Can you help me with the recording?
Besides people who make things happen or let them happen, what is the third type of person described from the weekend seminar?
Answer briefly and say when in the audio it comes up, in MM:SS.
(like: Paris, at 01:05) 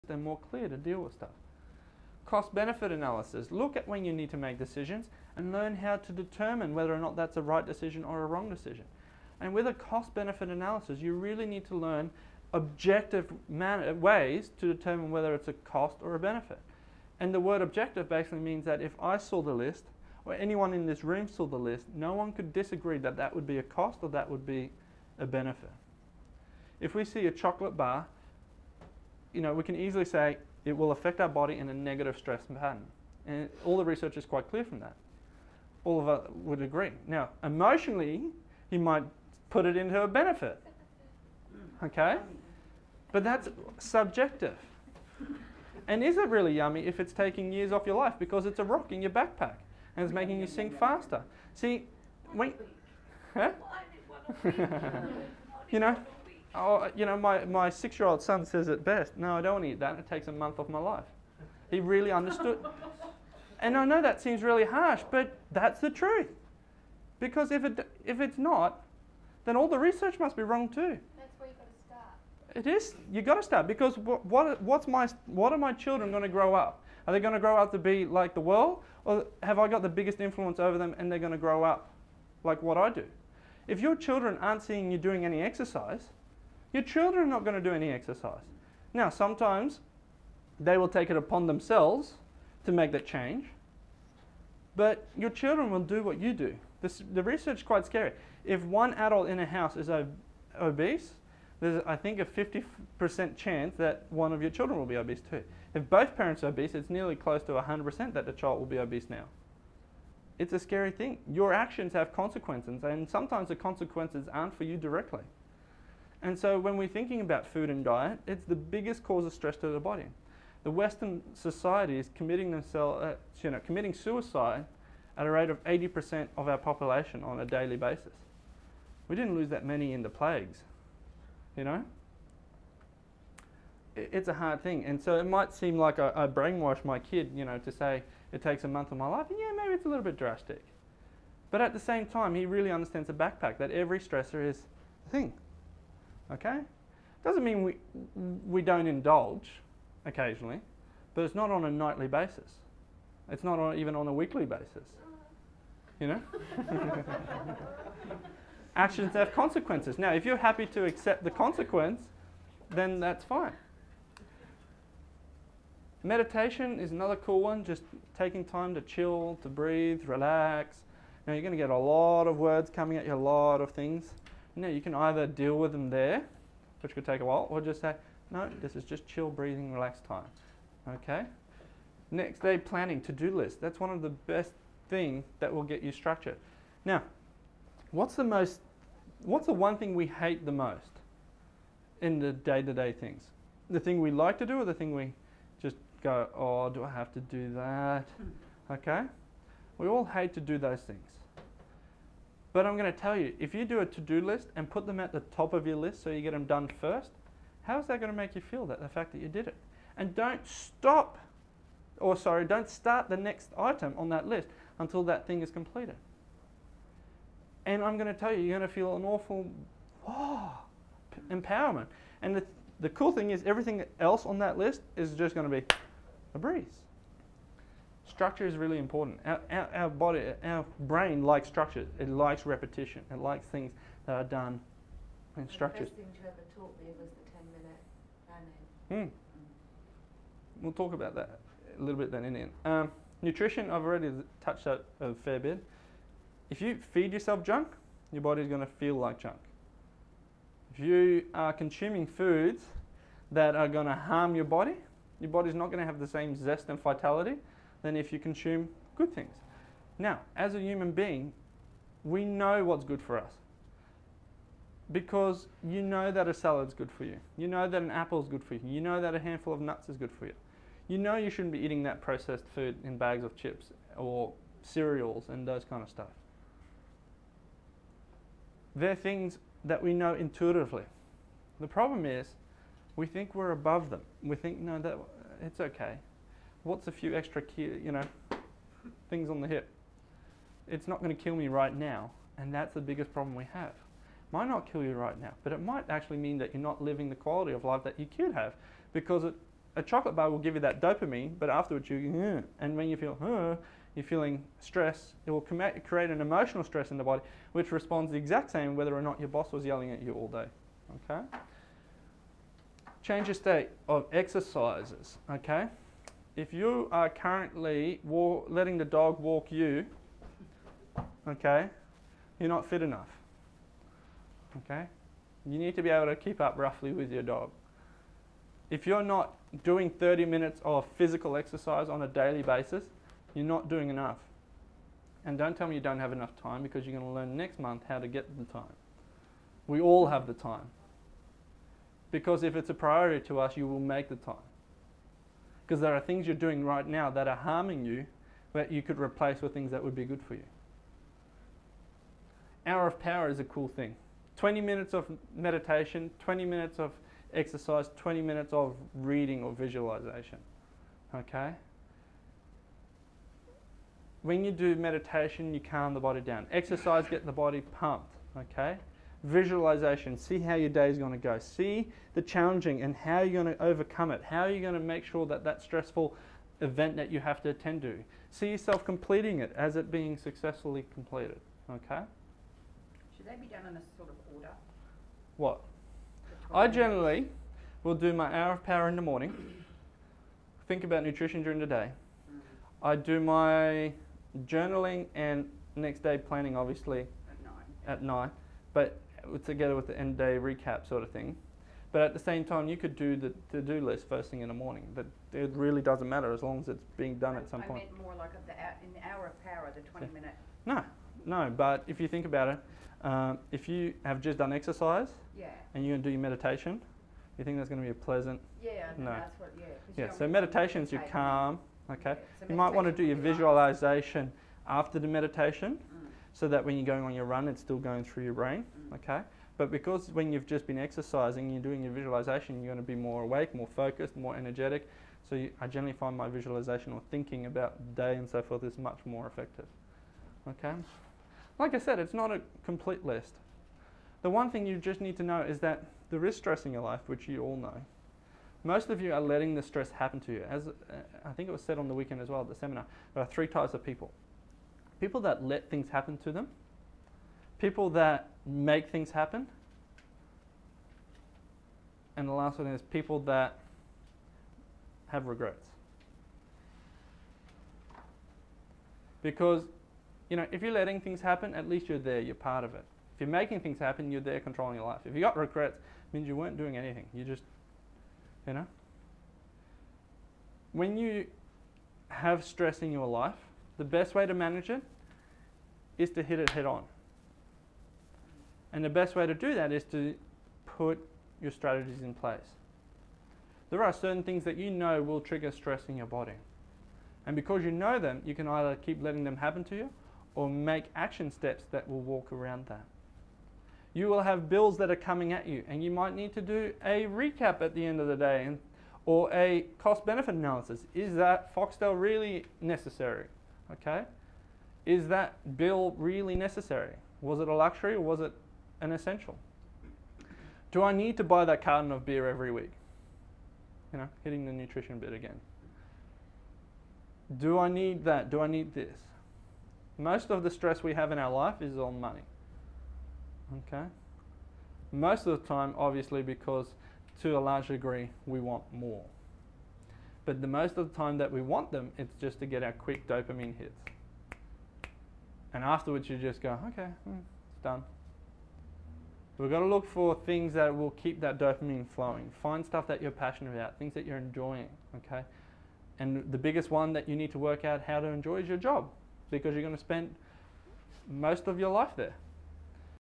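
people that have regrets, at 07:42.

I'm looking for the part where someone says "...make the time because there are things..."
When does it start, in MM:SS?
05:43.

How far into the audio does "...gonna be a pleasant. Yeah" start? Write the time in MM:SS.
06:57.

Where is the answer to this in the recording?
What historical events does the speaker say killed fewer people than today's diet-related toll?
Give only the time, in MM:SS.
02:10.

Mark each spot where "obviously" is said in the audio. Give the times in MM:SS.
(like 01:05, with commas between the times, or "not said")
06:36, 08:55.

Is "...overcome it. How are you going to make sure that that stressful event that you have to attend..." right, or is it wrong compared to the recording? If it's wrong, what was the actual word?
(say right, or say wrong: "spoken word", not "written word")
right.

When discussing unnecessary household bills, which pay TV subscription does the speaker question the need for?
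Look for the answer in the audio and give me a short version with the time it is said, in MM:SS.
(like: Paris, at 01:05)
Foxtel, at 08:31.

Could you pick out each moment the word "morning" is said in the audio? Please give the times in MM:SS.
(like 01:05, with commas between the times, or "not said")
06:29, 06:44.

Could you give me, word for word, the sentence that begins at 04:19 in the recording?
Now, as a human being, we know what's good for us because you know that a salad's good for you.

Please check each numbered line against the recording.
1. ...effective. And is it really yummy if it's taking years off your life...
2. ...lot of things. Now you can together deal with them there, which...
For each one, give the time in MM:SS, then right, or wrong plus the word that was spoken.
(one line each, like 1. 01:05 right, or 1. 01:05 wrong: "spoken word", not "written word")
1. 00:43 wrong: "subjective", not "effective"
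2. 02:53 wrong: "either", not "together".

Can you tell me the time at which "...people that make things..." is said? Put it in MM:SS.
07:37.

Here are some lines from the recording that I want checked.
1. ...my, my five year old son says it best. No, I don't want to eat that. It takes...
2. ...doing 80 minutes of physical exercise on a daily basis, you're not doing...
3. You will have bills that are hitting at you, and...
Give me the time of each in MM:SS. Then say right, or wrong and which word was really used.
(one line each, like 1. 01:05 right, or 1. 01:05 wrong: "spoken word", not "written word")
1. 00:57 wrong: "six", not "five"
2. 05:29 wrong: "30", not "80"
3. 08:23 wrong: "coming", not "hitting".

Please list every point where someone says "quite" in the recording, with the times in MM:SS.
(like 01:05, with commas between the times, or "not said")
00:34, 01:37.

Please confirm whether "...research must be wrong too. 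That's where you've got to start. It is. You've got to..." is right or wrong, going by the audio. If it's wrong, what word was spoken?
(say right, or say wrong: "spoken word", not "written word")
right.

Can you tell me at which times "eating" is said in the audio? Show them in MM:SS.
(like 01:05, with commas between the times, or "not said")
04:31.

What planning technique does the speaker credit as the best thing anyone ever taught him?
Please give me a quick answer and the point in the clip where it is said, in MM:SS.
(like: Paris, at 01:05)
10 minute planning, at 03:58.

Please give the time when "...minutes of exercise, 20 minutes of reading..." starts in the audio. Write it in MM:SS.
05:56.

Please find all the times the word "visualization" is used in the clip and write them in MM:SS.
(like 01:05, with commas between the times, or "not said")
05:59, 06:09, 07:03, 07:11, 07:16.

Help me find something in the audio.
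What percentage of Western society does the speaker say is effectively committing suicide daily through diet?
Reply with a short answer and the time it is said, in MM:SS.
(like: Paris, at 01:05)
80%, at 02:05.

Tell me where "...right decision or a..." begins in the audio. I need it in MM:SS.
00:07.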